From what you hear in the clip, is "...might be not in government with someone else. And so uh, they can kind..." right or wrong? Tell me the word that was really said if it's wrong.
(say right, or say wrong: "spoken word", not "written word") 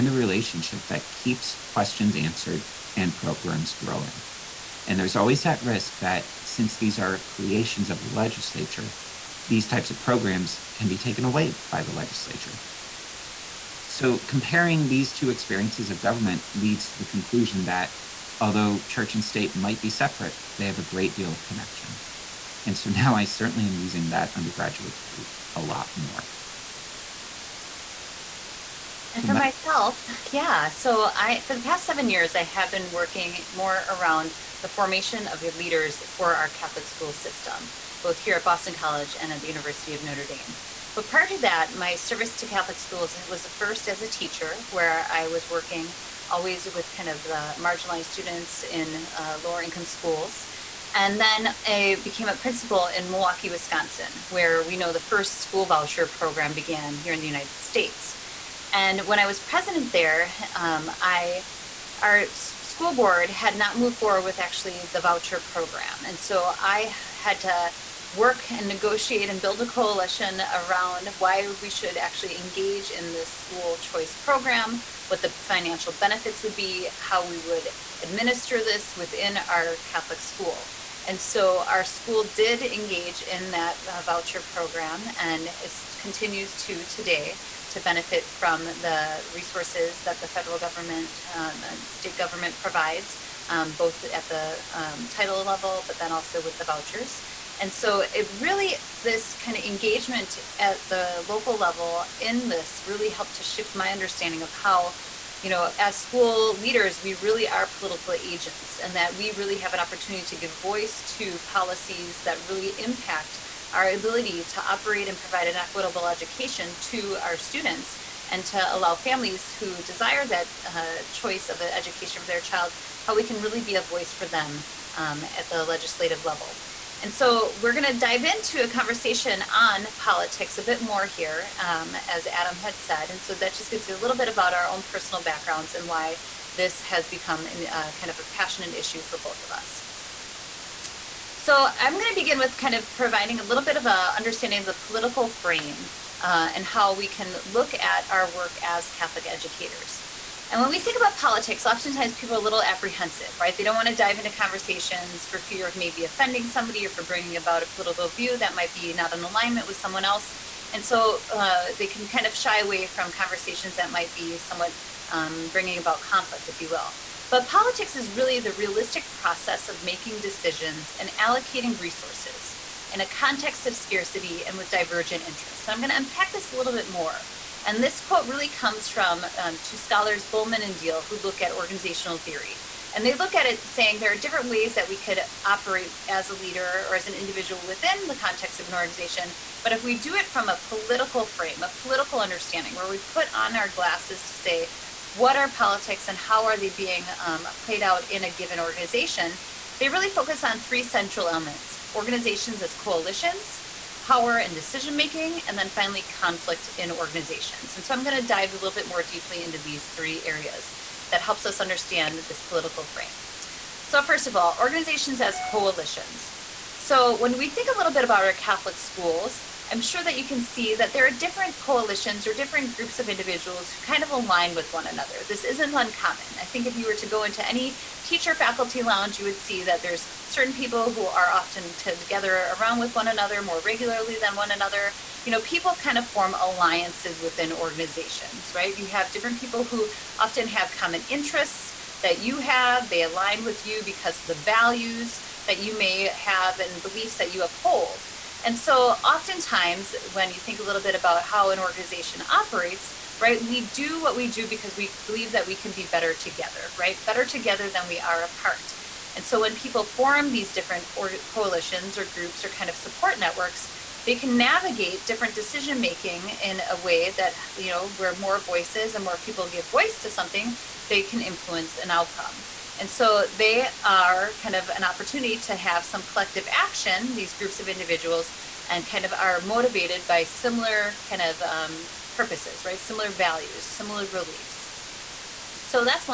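wrong: "alignment", not "government".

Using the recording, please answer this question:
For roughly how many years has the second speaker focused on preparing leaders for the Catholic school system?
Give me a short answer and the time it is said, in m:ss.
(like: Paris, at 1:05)
7, at 0:31.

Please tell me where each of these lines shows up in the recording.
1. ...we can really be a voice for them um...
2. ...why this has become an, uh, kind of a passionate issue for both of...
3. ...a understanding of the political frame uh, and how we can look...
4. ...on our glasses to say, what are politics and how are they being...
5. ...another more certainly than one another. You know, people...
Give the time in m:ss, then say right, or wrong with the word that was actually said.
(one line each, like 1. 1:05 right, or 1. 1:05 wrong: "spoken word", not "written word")
1. 2:03 right
2. 2:15 right
3. 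2:23 right
4. 3:13 right
5. 3:53 wrong: "regularly", not "certainly".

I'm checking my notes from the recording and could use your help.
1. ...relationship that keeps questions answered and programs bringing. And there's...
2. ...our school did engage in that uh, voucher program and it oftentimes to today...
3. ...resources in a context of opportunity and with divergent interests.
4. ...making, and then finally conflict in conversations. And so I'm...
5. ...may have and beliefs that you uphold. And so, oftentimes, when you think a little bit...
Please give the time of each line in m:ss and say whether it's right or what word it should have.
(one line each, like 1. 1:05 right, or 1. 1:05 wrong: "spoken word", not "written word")
1. 0:00 wrong: "growing", not "bringing"
2. 1:21 wrong: "continues", not "oftentimes"
3. 2:51 wrong: "scarcity", not "opportunity"
4. 3:24 wrong: "organizations", not "conversations"
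5. 4:05 right.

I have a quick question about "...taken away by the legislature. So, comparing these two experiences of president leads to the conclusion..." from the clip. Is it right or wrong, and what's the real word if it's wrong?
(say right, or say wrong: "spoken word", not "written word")
wrong: "government", not "president".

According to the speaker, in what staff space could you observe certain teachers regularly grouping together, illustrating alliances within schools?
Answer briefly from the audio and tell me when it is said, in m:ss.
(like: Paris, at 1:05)
faculty lounge, at 3:48.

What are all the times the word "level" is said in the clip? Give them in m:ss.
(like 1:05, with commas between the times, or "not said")
1:35, 1:41, 2:06.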